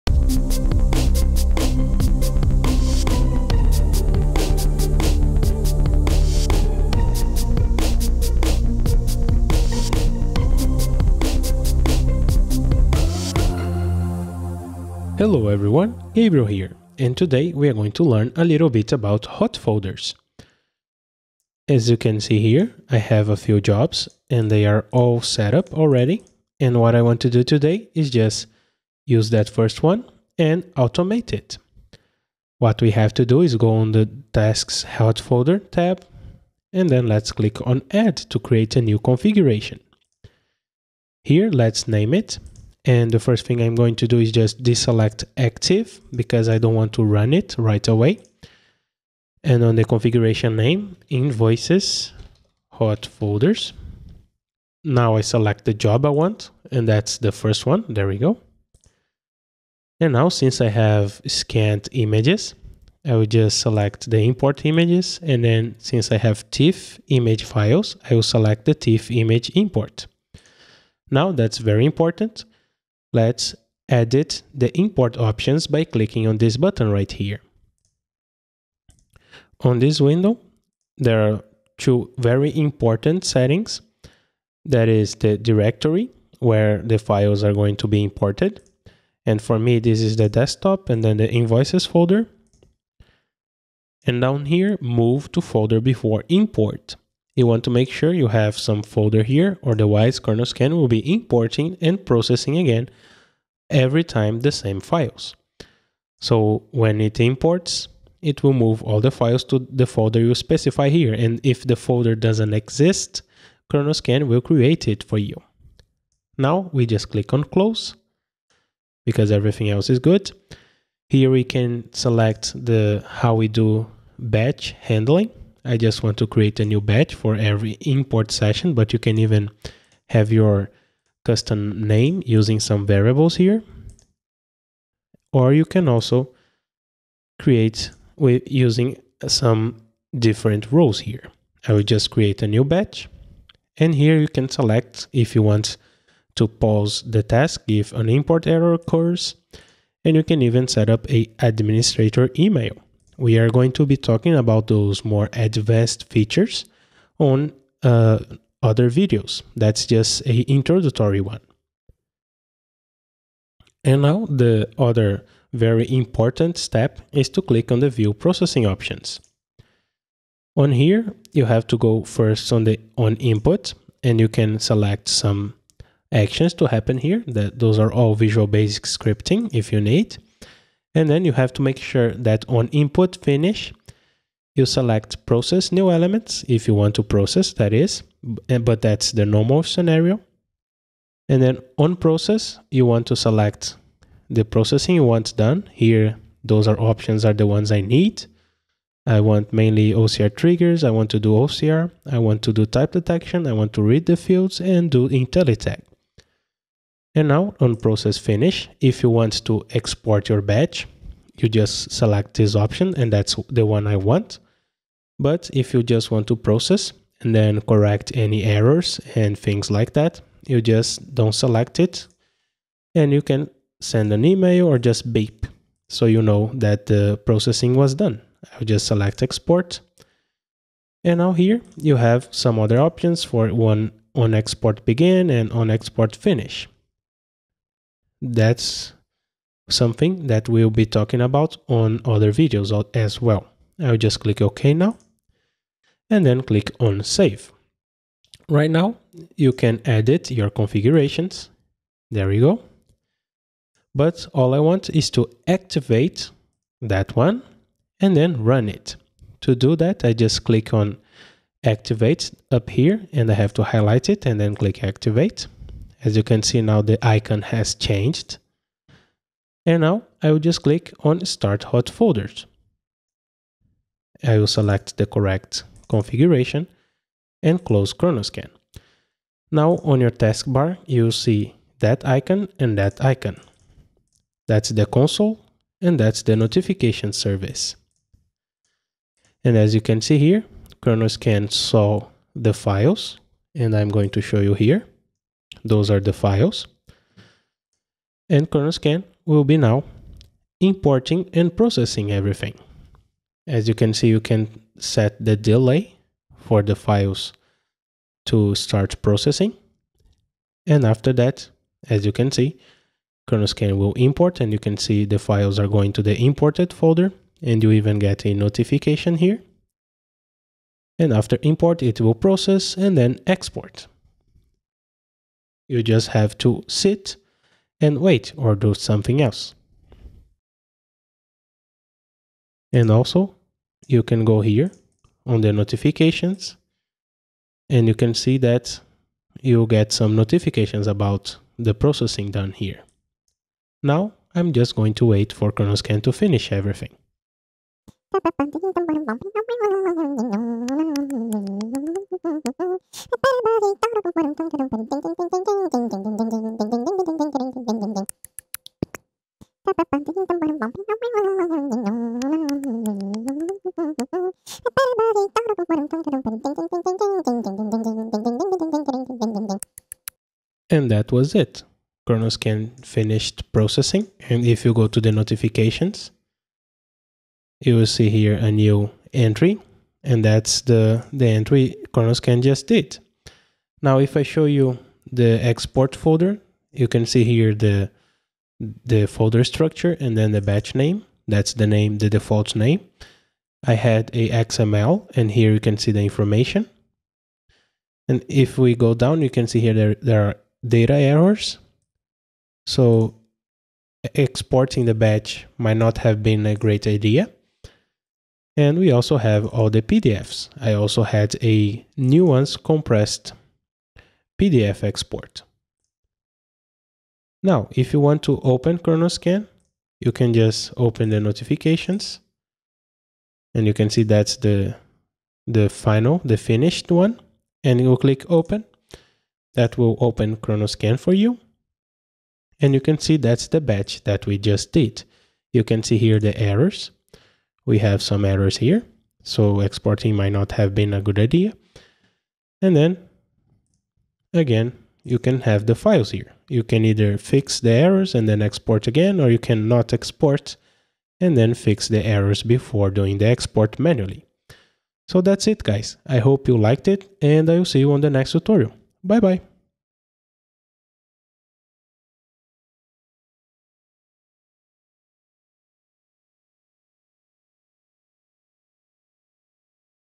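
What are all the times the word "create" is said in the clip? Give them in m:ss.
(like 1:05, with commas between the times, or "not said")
0:38, 1:54, 2:06, 2:17, 2:22.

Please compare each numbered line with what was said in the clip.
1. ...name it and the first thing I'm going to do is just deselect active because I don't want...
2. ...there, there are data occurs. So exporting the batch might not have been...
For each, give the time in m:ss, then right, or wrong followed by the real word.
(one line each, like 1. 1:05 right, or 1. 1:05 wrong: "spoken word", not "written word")
1. 0:41 right
2. 6:39 wrong: "errors", not "occurs".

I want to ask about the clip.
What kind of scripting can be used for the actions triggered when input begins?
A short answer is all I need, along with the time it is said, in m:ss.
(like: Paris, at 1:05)
Visual Basic scripting, at 2:58.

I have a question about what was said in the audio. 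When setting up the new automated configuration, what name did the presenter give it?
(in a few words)
Invoices, hot folders.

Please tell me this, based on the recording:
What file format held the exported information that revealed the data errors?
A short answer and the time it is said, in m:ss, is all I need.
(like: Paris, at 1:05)
XML, at 6:34.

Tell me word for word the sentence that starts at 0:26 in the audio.
And what I want to do today is just use that first one and automate it.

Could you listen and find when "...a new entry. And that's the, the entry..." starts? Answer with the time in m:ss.
6:18.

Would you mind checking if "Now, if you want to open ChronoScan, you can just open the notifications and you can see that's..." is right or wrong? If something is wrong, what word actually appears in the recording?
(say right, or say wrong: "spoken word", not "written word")
right.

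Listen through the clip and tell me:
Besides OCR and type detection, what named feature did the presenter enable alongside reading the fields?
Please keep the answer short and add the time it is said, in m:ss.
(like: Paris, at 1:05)
IntelliTag, at 3:25.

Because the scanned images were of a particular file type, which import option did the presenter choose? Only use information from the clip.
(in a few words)
TIFF image import.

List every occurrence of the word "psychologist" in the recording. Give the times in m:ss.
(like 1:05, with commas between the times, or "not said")
not said.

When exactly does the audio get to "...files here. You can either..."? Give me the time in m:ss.
7:25.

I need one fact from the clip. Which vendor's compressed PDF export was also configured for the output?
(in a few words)
Nuance.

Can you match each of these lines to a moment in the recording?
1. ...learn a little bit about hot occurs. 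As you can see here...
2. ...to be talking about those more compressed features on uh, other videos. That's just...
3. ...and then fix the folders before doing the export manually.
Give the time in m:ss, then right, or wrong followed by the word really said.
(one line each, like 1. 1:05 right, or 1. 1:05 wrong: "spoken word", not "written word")
1. 0:18 wrong: "folders", not "occurs"
2. 2:33 wrong: "advanced", not "compressed"
3. 7:31 wrong: "errors", not "folders".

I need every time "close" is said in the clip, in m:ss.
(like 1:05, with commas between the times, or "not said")
1:57, 4:37.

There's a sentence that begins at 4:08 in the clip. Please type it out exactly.
Right now, you can edit your configurations.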